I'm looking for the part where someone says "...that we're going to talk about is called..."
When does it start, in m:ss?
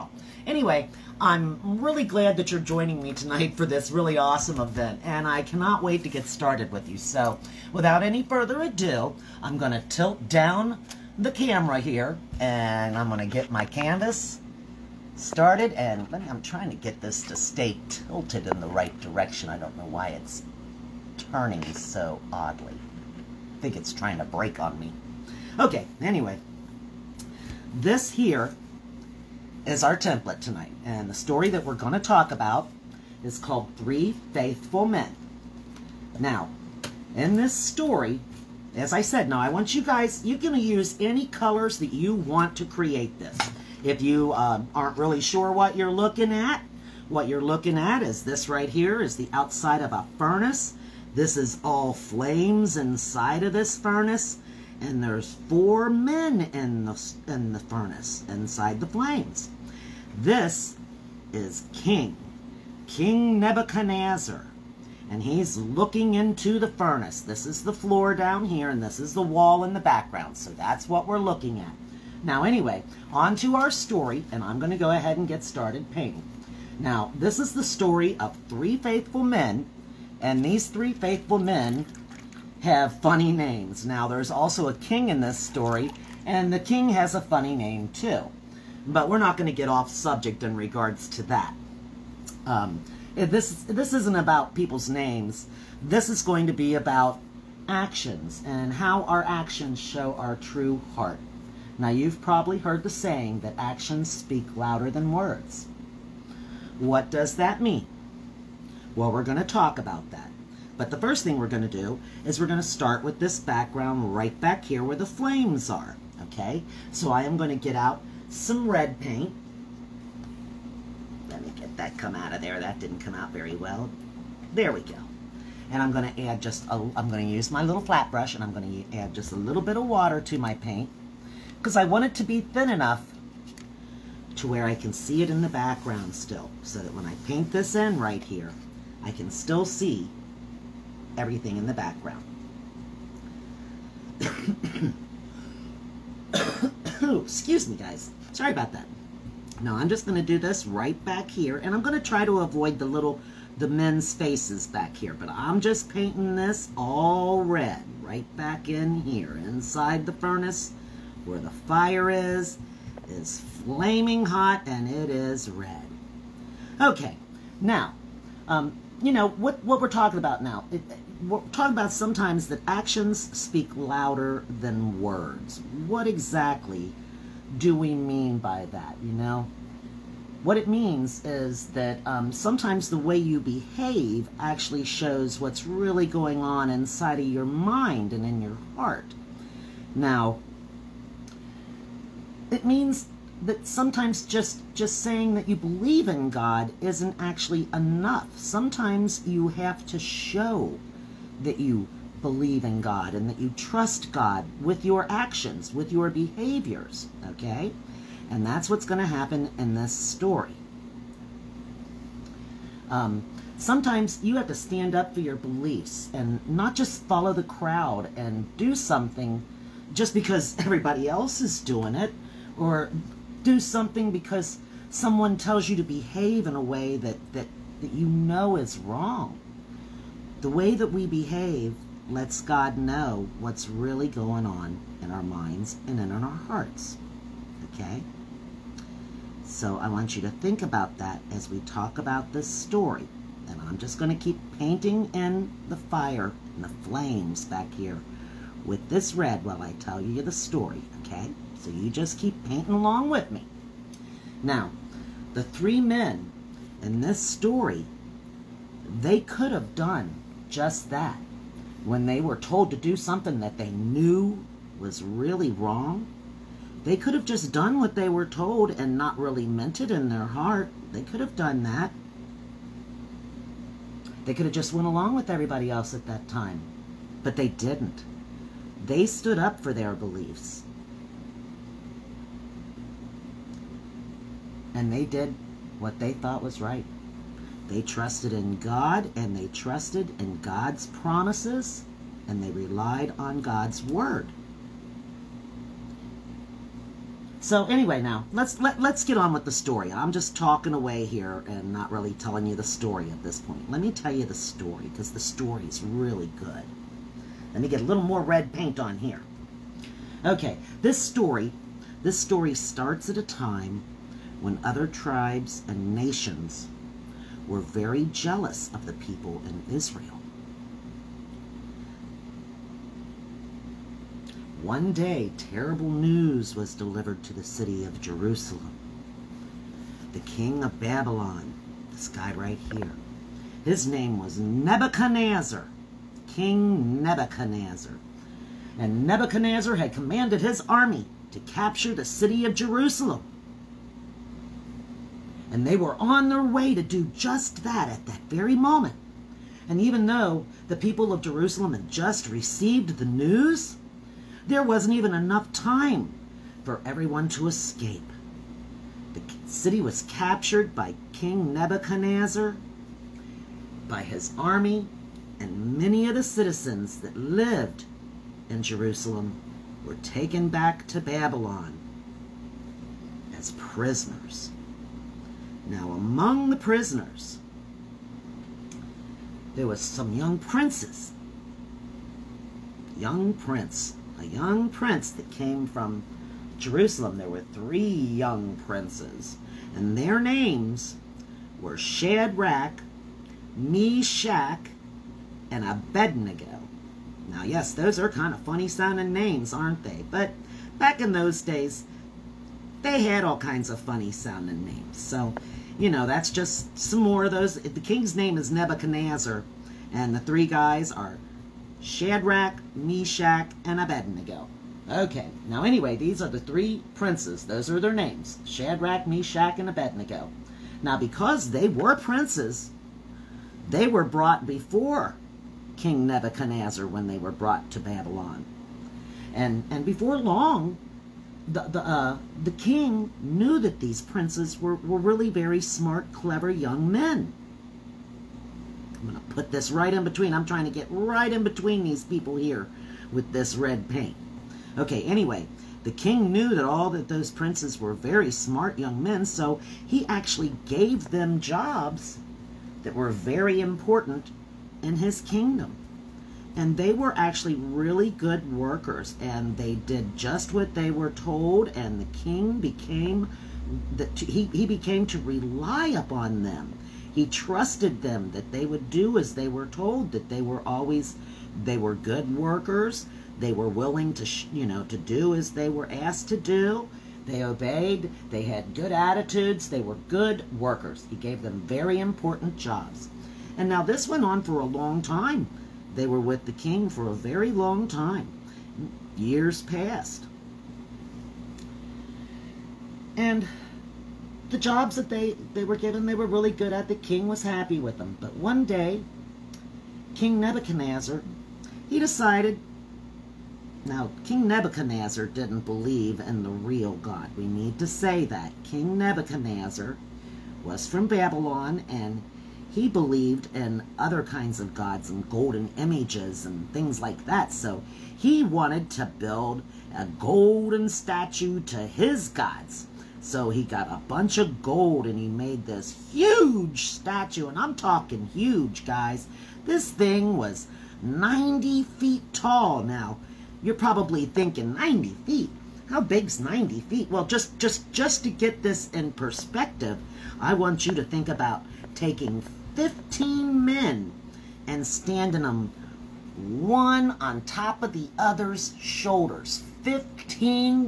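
0:31.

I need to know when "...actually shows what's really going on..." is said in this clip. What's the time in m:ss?
3:04.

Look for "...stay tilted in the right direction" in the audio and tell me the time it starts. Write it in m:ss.
0:17.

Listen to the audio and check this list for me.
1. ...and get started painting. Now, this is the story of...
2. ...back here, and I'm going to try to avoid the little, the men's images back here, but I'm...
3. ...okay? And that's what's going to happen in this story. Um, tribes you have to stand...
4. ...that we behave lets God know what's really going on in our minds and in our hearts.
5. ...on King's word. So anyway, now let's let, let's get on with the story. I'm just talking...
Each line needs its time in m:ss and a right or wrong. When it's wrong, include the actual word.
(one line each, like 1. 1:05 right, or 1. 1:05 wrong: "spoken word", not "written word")
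1. 1:15 right
2. 2:31 wrong: "faces", not "images"
3. 3:27 wrong: "sometimes", not "tribes"
4. 3:50 right
5. 4:53 wrong: "God", not "King".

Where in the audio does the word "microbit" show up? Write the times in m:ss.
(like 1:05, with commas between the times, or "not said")
not said.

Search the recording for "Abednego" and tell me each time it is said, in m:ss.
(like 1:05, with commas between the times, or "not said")
6:35, 6:53, 6:59.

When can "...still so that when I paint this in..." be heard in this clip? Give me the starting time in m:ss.
2:16.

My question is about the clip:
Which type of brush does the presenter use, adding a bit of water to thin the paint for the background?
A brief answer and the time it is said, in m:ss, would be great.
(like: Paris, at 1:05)
Little flat brush, at 2:07.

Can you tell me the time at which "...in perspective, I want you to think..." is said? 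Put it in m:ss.
8:58.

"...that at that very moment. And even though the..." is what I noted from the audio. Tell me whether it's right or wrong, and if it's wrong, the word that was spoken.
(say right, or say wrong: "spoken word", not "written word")
right.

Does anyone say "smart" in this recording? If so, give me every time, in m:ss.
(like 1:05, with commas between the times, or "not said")
7:15, 7:28.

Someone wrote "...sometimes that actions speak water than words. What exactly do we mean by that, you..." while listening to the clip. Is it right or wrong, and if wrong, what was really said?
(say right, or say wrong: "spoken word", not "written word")
wrong: "louder", not "water".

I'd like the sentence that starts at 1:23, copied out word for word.
Now, there's also a king in this story, and the king has a funny name too.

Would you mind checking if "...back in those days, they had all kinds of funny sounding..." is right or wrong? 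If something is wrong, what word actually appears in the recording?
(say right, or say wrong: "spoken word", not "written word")
right.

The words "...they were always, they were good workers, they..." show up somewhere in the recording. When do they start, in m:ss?
7:50.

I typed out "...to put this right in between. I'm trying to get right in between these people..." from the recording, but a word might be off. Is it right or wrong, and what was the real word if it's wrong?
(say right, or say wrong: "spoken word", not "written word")
right.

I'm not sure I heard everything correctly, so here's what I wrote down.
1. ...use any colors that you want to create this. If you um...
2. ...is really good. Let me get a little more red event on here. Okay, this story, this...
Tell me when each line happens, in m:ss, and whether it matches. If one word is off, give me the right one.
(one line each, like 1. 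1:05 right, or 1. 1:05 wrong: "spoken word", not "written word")
1. 0:40 right
2. 5:05 wrong: "paint", not "event".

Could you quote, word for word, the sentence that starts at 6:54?
Okay, now anyway, these are the three princes.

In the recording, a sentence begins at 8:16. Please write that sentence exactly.
The king was happy with them.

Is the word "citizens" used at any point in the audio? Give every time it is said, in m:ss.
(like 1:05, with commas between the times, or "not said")
6:06.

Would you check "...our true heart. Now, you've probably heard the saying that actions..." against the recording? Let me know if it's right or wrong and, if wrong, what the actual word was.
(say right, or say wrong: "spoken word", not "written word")
right.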